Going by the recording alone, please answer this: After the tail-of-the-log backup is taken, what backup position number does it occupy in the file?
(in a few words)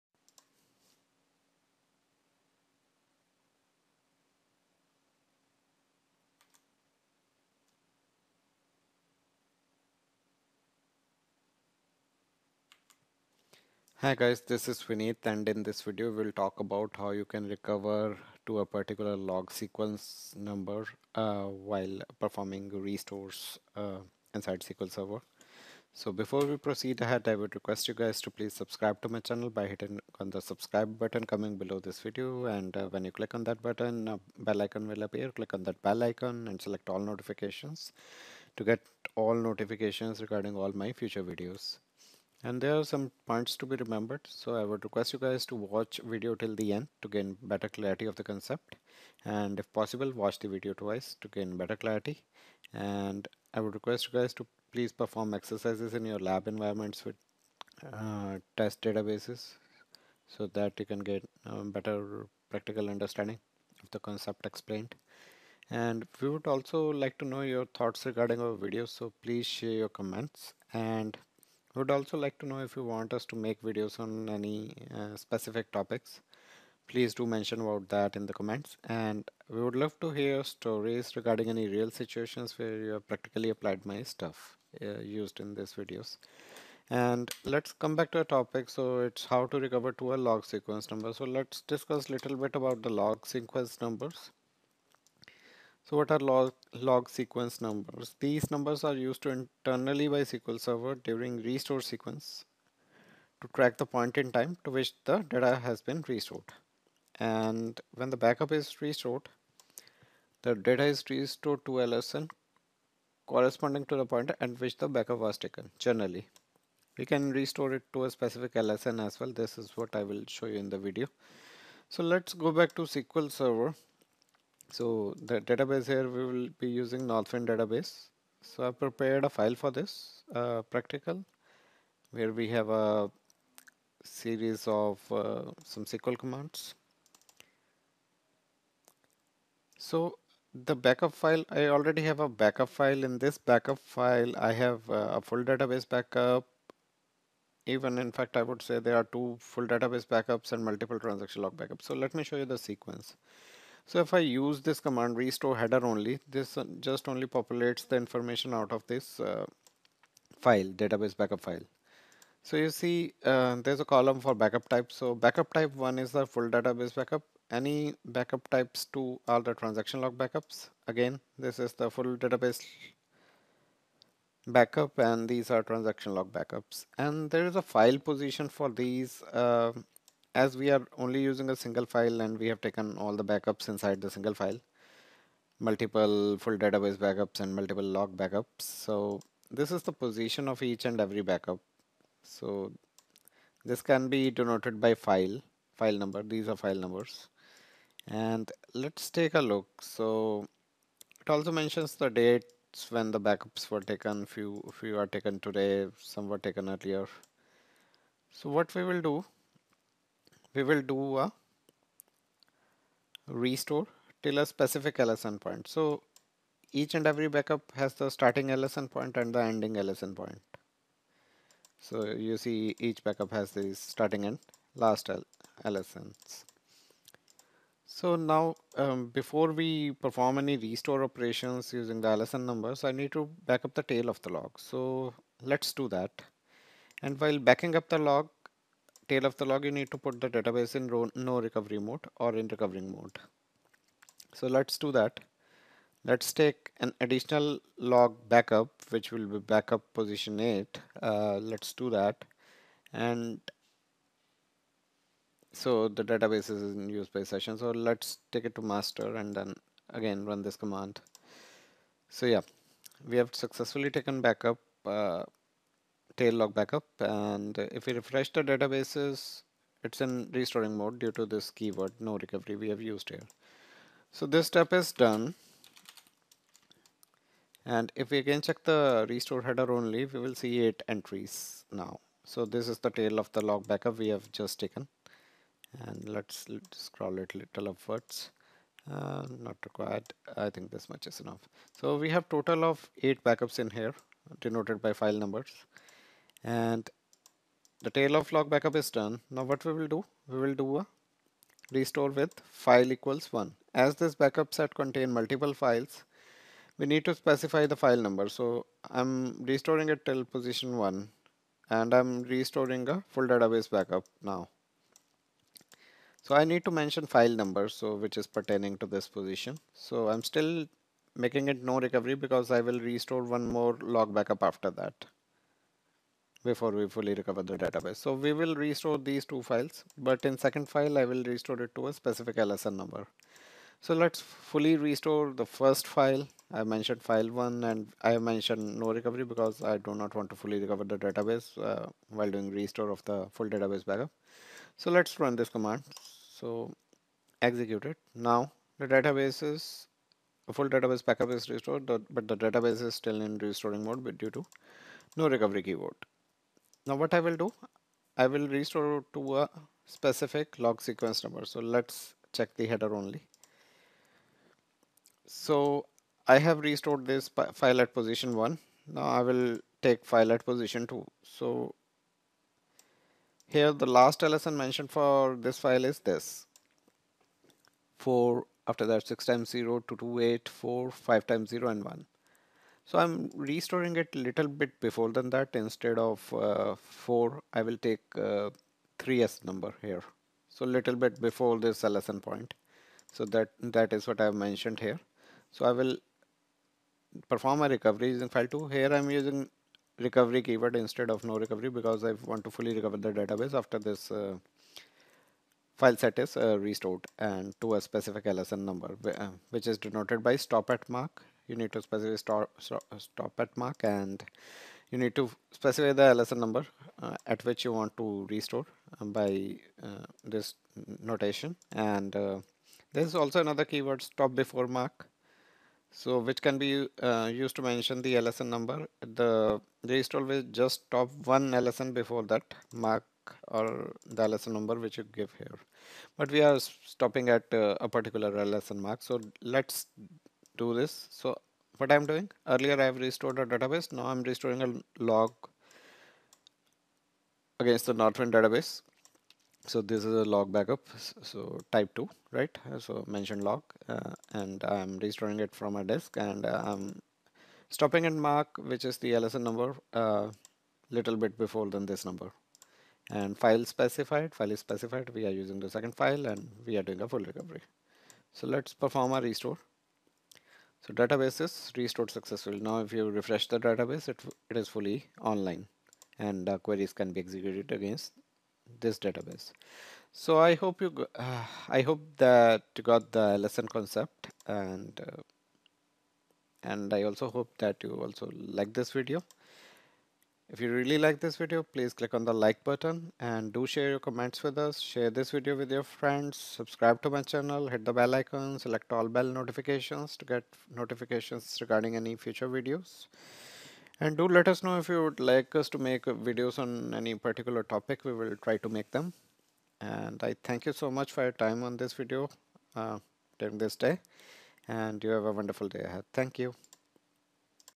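8.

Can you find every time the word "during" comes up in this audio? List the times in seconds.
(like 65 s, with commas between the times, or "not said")
100 s, 513 s.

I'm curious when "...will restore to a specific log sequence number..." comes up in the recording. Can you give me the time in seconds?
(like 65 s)
358 s.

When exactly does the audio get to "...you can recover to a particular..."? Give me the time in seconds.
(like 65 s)
17 s.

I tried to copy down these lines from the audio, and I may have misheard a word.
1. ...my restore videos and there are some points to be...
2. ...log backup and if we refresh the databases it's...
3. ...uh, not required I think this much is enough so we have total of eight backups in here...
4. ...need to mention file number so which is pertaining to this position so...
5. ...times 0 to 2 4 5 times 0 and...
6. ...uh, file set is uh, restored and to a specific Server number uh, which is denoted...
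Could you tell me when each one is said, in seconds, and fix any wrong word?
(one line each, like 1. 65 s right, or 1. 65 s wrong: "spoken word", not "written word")
1. 40 s wrong: "future", not "restore"
2. 266 s right
3. 288 s right
4. 316 s right
5. 379 s right
6. 404 s wrong: "LSN", not "Server".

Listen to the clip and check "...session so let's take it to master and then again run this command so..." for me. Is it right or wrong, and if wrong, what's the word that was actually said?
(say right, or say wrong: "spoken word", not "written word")
right.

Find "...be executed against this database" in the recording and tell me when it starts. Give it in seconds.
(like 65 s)
477 s.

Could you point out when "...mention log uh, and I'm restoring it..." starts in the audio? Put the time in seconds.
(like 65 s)
453 s.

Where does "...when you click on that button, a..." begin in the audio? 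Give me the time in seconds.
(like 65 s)
32 s.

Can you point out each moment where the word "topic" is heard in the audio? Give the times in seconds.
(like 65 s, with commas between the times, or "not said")
75 s, 88 s, 507 s.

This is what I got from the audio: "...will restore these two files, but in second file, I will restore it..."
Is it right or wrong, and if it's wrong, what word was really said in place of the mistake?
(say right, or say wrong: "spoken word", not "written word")
right.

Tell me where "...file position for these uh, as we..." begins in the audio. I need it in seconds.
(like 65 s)
177 s.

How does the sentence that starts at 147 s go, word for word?
Even in fact, I would say there are two full database backups and multiple transaction log backups.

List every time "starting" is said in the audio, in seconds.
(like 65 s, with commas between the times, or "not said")
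218 s, 223 s.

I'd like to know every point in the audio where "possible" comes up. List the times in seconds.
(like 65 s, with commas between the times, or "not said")
49 s.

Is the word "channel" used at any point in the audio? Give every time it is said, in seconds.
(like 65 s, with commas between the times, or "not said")
29 s, 497 s.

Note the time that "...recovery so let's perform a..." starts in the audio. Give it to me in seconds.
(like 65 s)
467 s.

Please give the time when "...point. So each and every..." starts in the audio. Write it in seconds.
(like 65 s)
215 s.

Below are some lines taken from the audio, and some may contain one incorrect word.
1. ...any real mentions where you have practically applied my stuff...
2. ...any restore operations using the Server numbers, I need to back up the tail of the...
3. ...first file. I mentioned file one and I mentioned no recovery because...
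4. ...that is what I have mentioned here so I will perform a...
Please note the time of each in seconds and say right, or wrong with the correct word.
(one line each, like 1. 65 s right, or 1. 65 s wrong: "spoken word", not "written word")
1. 81 s wrong: "situations", not "mentions"
2. 230 s wrong: "LSN", not "Server"
3. 335 s right
4. 393 s right.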